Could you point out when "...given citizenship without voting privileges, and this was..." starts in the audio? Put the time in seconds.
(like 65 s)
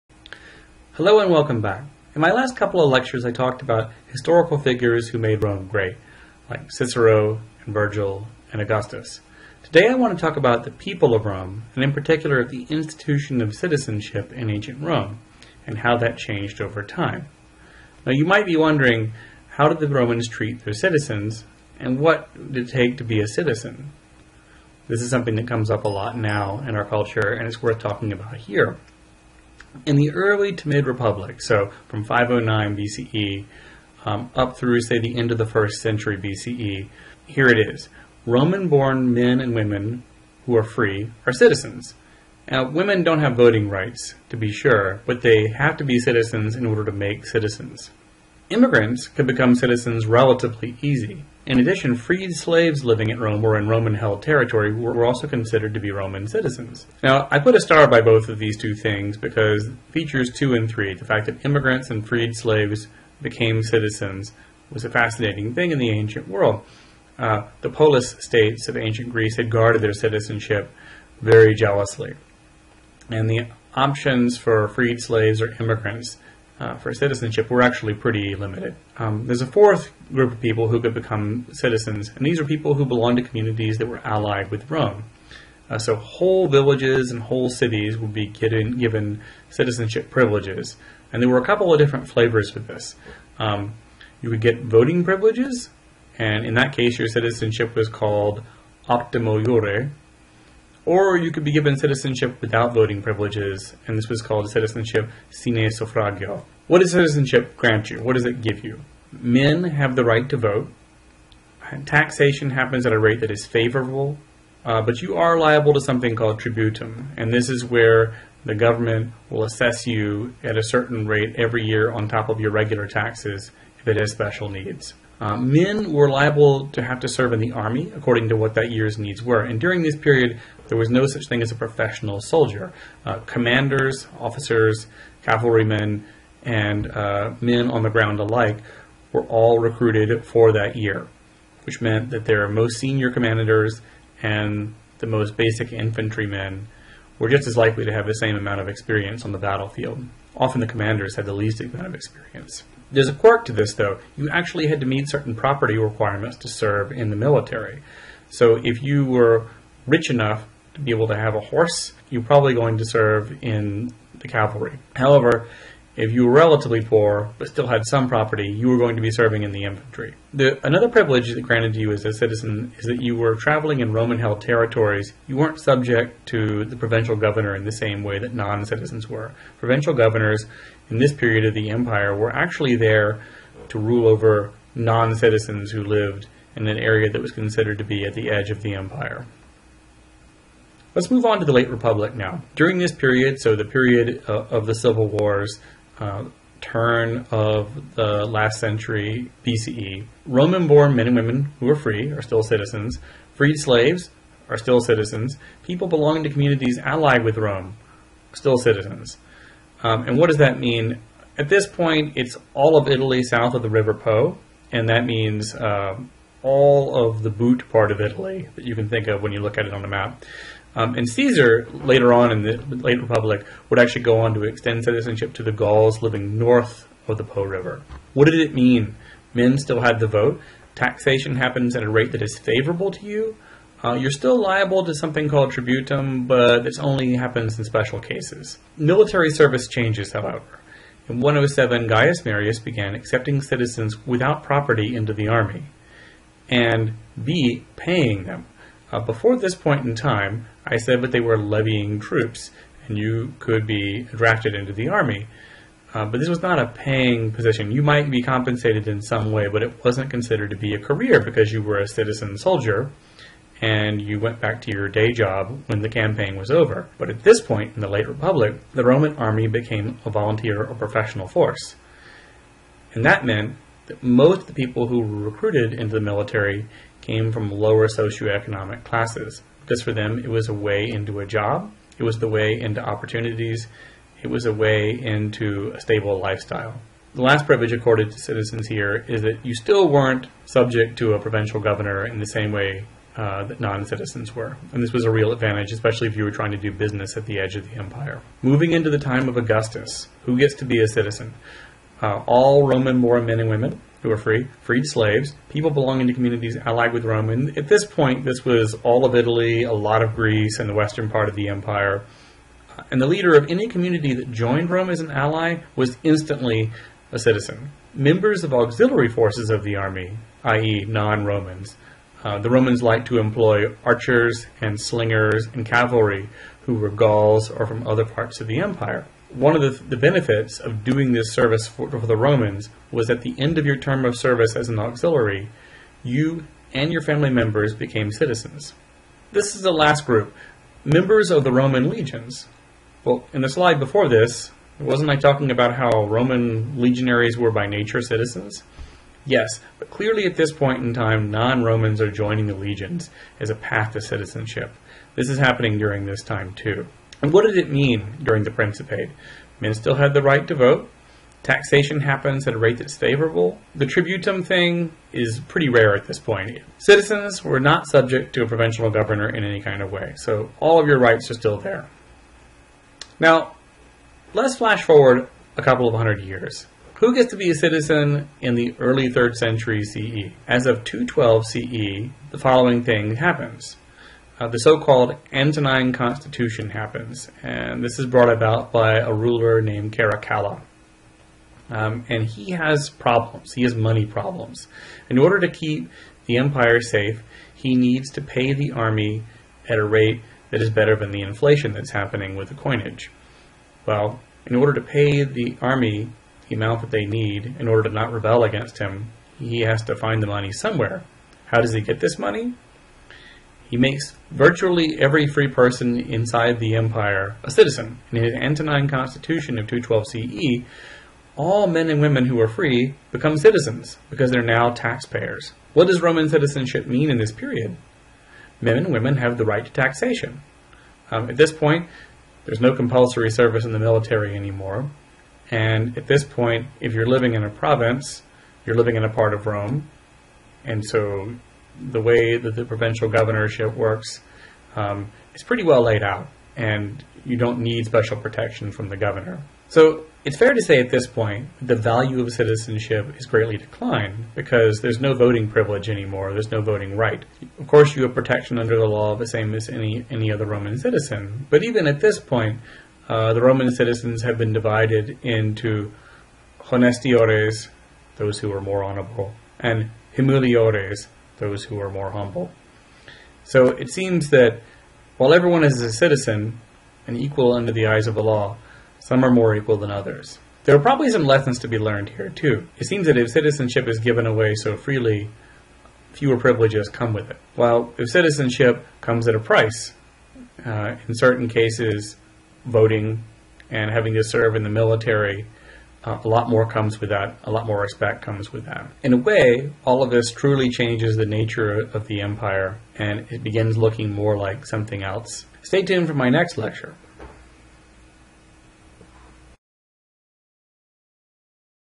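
101 s.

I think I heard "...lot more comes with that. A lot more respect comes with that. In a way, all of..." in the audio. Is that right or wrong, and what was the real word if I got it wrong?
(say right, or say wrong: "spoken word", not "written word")
right.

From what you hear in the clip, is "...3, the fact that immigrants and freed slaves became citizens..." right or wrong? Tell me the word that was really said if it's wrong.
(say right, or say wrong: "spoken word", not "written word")
right.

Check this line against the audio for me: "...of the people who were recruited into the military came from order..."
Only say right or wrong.
wrong.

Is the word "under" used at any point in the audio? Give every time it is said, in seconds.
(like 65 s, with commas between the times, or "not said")
458 s, 477 s.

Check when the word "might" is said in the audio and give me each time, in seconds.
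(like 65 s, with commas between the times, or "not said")
18 s, 257 s.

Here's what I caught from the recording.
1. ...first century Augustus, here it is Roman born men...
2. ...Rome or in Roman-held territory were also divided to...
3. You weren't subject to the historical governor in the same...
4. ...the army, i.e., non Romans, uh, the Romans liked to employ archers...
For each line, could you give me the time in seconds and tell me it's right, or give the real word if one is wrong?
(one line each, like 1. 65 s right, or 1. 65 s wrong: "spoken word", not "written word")
1. 35 s wrong: "BCE", not "Augustus"
2. 53 s wrong: "considered", not "divided"
3. 175 s wrong: "provincial", not "historical"
4. 319 s right.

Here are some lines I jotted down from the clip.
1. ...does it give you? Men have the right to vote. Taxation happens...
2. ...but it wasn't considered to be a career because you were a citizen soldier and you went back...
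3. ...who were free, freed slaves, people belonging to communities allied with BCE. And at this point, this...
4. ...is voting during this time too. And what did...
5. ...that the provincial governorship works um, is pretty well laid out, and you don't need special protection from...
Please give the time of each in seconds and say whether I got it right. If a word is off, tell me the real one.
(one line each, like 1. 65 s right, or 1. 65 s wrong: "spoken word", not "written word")
1. 108 s right
2. 259 s right
3. 304 s wrong: "Rome", not "BCE"
4. 355 s wrong: "happening", not "voting"
5. 442 s right.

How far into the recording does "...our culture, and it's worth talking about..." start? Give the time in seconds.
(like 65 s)
26 s.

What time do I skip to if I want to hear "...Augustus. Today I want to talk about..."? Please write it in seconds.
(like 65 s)
8 s.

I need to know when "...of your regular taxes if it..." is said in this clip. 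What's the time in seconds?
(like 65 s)
122 s.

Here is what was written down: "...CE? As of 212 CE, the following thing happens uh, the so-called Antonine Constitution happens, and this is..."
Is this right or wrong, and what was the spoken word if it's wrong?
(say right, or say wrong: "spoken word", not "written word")
right.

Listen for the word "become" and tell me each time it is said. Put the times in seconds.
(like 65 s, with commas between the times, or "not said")
49 s, 80 s, 423 s.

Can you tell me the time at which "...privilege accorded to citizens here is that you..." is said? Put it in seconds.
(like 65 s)
287 s.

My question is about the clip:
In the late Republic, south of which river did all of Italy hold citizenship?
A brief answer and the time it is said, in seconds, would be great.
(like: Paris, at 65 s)
River Po, at 213 s.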